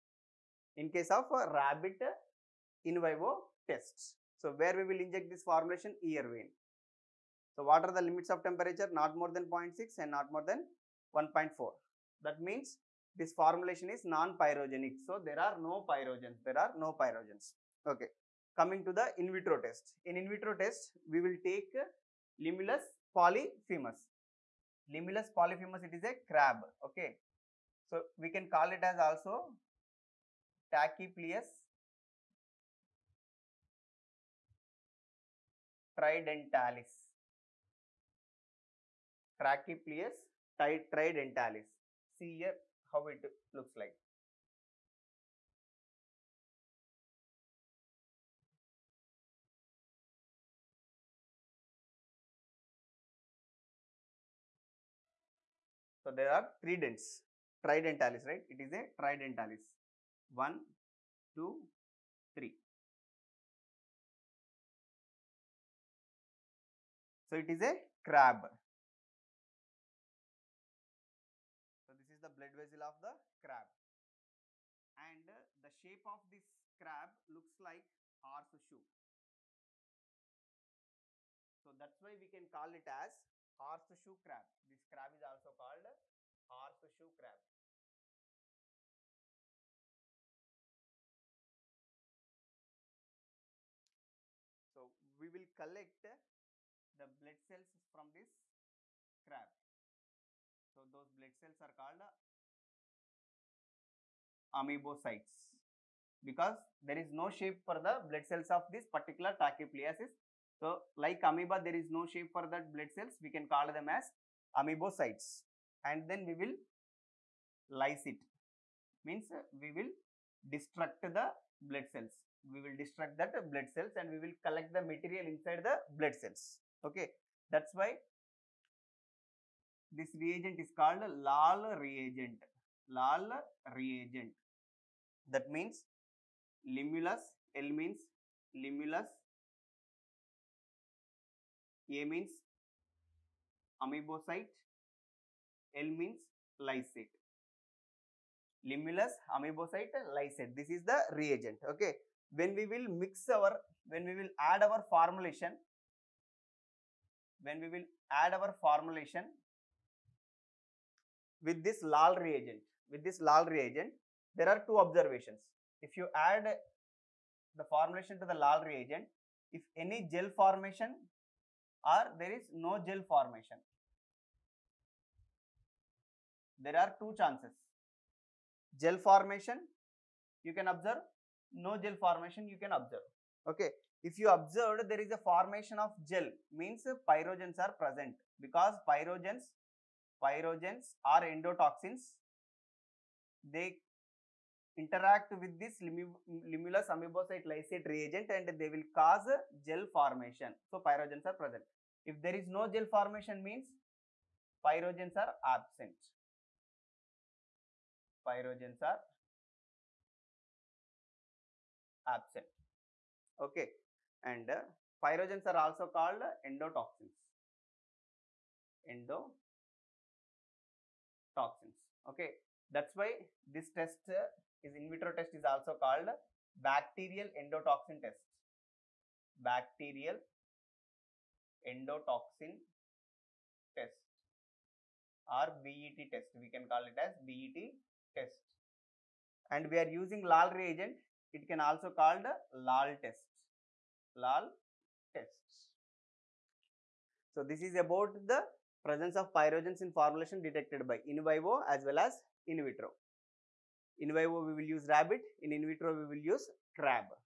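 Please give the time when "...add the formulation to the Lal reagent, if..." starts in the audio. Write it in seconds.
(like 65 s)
166 s.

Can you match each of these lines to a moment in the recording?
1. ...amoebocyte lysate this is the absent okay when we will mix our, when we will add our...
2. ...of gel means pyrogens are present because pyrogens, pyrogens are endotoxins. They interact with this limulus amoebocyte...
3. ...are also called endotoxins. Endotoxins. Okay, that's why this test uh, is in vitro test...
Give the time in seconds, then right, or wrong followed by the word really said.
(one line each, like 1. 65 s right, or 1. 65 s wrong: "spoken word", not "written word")
1. 149 s wrong: "reagent", not "absent"
2. 185 s right
3. 215 s right.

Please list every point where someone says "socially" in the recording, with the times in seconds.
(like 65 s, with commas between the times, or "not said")
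not said.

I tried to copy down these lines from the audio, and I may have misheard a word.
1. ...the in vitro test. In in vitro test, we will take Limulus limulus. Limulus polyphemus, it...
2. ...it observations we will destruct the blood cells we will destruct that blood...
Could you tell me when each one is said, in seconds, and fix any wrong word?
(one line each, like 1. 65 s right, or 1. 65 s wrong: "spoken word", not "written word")
1. 18 s wrong: "polyphemus", not "limulus"
2. 118 s wrong: "means", not "observations".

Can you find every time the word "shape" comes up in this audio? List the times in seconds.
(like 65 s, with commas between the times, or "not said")
75 s, 107 s, 112 s.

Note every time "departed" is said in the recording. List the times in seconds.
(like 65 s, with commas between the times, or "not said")
not said.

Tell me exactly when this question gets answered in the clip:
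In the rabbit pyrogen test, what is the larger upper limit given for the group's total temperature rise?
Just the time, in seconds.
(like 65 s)
10 s.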